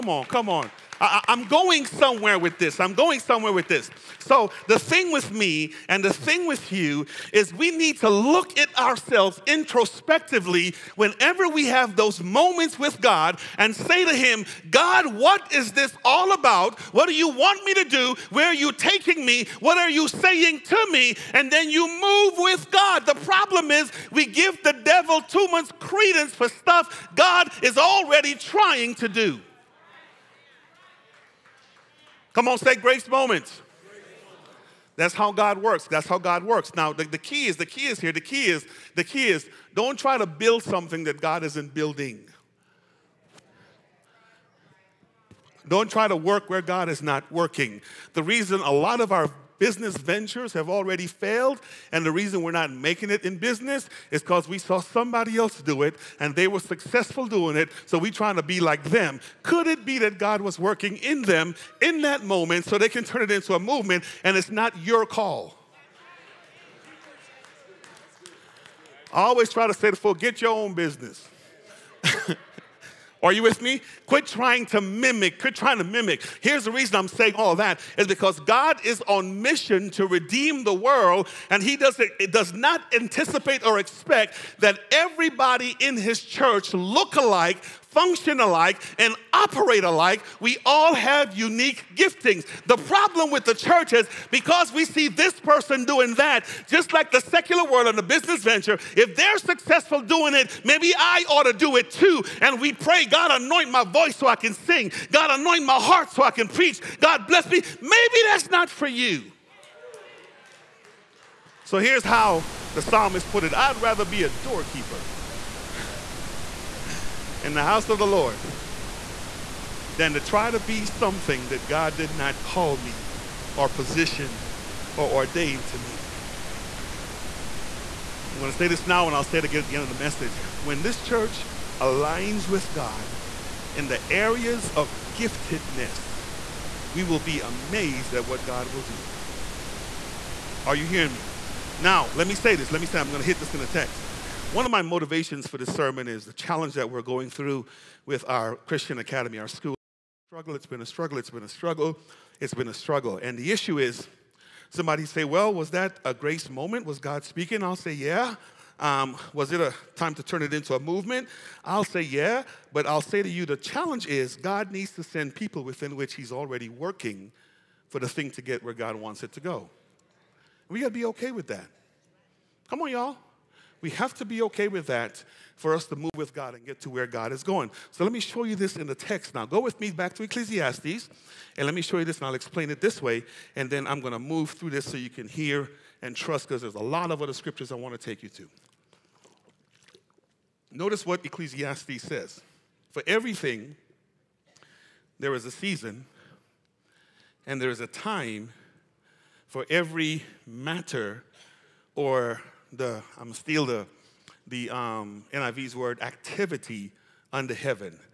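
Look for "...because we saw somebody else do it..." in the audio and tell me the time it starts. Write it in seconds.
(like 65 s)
54 s.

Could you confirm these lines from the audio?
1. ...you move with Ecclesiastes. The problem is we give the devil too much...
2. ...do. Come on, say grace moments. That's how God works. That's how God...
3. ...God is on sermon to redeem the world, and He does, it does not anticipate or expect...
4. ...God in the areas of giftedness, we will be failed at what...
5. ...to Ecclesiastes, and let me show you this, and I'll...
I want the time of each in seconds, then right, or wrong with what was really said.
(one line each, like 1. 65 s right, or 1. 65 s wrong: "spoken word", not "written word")
1. 21 s wrong: "God", not "Ecclesiastes"
2. 29 s right
3. 78 s wrong: "mission", not "sermon"
4. 132 s wrong: "amazed", not "failed"
5. 180 s right.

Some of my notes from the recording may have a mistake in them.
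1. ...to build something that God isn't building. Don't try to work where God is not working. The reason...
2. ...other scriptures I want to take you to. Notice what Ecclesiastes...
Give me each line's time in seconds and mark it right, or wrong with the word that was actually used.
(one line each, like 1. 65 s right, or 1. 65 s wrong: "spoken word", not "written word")
1. 40 s right
2. 187 s right.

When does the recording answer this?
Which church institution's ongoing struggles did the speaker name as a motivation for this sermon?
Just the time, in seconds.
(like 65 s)
148 s.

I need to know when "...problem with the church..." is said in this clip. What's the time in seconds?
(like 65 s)
92 s.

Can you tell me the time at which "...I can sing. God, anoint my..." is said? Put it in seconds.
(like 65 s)
104 s.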